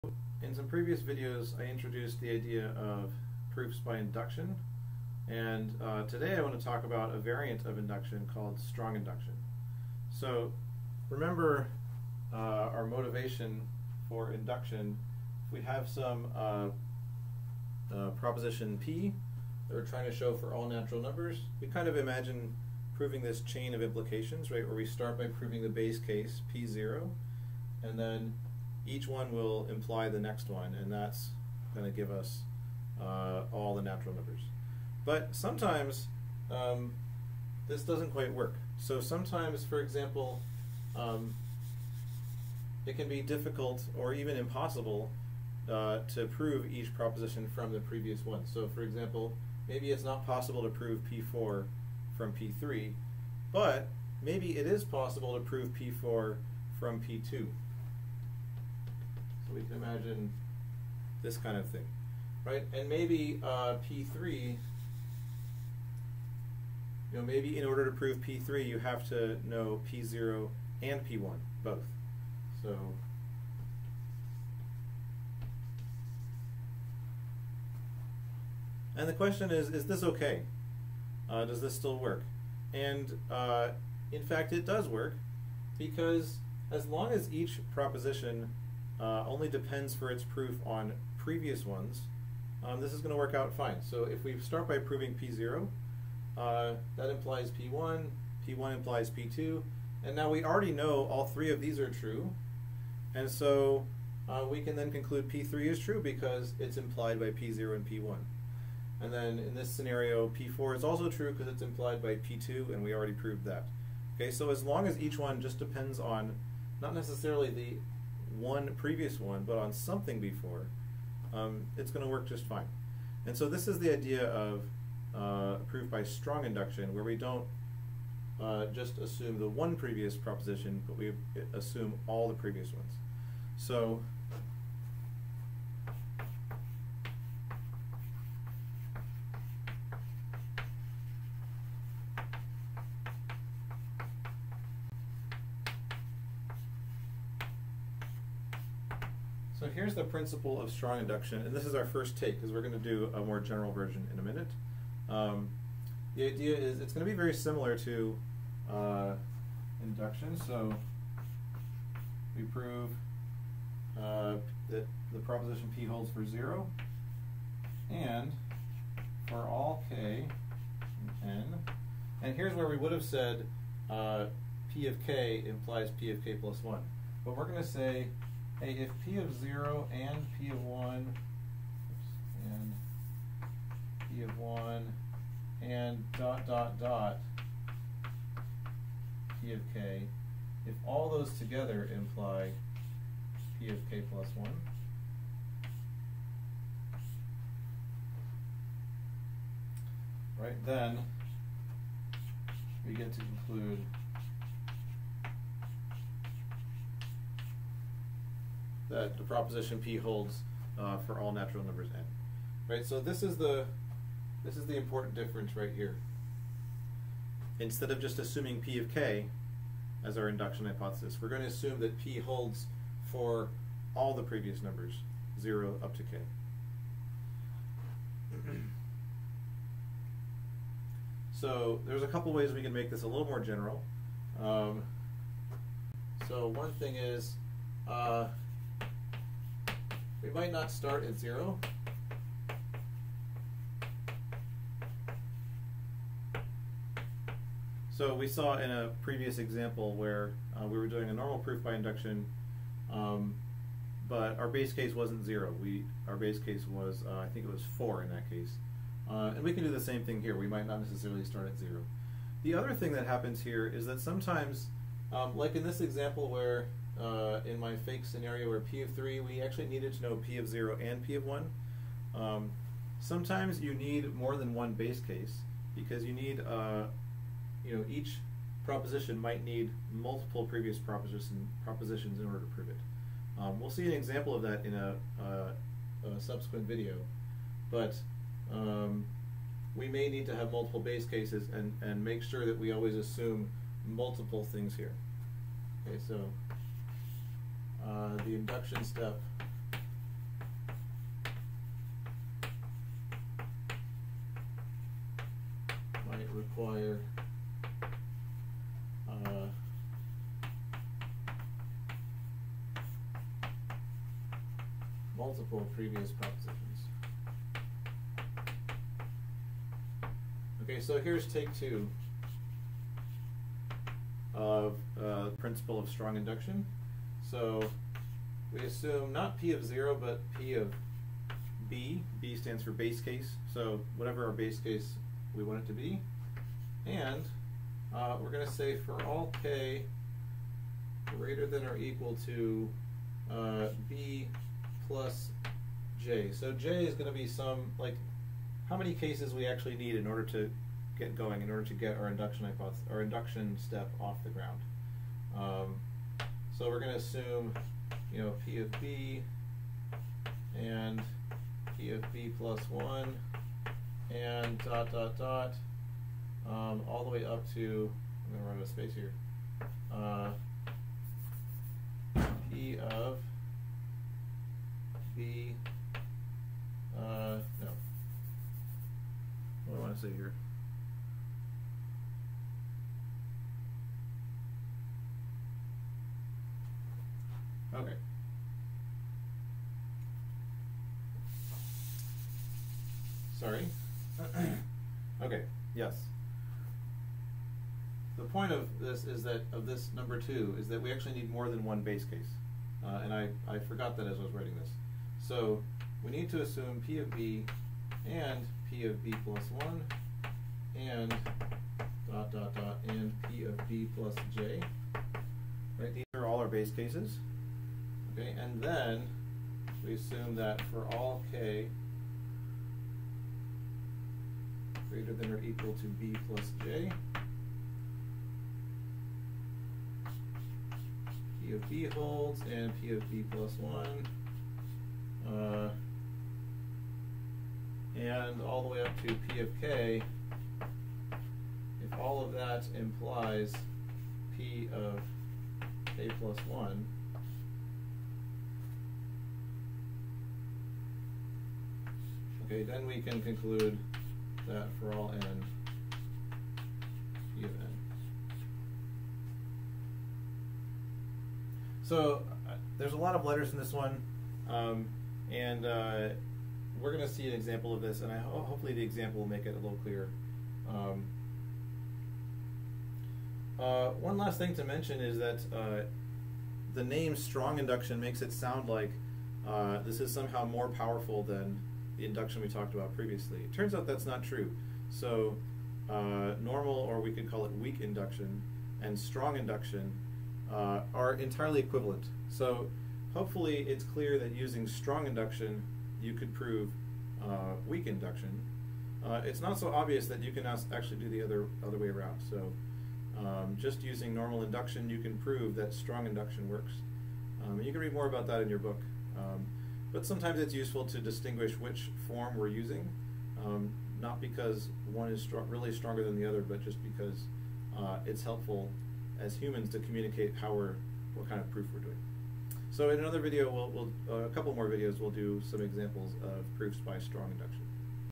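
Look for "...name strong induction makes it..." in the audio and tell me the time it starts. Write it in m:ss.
7:56.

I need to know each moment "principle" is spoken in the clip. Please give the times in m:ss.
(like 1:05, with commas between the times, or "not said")
2:30, 5:25.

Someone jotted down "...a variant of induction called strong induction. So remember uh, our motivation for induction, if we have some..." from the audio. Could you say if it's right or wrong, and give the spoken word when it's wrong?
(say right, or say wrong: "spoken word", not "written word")
right.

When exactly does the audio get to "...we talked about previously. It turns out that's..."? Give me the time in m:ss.
8:02.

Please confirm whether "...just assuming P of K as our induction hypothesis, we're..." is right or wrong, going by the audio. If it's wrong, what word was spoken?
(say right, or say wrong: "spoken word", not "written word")
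right.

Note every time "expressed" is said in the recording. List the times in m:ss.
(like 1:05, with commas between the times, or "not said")
not said.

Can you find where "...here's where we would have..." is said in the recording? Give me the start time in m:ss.
2:52.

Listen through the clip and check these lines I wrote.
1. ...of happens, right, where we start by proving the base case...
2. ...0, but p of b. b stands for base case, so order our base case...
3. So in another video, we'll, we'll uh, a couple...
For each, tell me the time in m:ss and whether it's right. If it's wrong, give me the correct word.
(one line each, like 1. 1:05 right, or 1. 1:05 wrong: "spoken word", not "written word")
1. 0:23 wrong: "implications", not "happens"
2. 5:29 wrong: "whatever", not "order"
3. 8:42 right.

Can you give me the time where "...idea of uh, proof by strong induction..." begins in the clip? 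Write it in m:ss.
2:03.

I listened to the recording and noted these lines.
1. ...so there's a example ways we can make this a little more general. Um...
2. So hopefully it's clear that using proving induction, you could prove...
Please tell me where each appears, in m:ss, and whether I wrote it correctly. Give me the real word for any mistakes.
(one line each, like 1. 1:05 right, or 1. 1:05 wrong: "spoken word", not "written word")
1. 3:51 wrong: "couple", not "example"
2. 8:12 wrong: "strong", not "proving".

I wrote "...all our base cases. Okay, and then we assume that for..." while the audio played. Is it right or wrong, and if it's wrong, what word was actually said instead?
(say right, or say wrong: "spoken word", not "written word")
right.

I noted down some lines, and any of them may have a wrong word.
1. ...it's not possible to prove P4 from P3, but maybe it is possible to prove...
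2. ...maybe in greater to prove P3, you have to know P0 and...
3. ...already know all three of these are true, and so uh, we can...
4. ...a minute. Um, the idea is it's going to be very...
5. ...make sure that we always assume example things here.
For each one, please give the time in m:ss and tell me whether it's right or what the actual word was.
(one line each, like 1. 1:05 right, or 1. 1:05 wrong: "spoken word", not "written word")
1. 0:49 right
2. 1:07 wrong: "order", not "greater"
3. 1:40 right
4. 2:34 right
5. 4:52 wrong: "multiple", not "example".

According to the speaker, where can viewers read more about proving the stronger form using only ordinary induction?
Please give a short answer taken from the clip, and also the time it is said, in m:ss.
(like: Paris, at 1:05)
in your book, at 8:28.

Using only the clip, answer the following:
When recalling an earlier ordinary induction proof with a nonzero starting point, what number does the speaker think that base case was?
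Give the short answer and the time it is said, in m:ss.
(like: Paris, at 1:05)
4, at 4:17.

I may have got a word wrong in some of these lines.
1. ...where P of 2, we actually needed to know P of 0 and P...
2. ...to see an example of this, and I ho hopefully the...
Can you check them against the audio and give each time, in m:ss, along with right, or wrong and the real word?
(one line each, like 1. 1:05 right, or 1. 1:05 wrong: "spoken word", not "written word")
1. 4:28 wrong: "3", not "2"
2. 7:47 right.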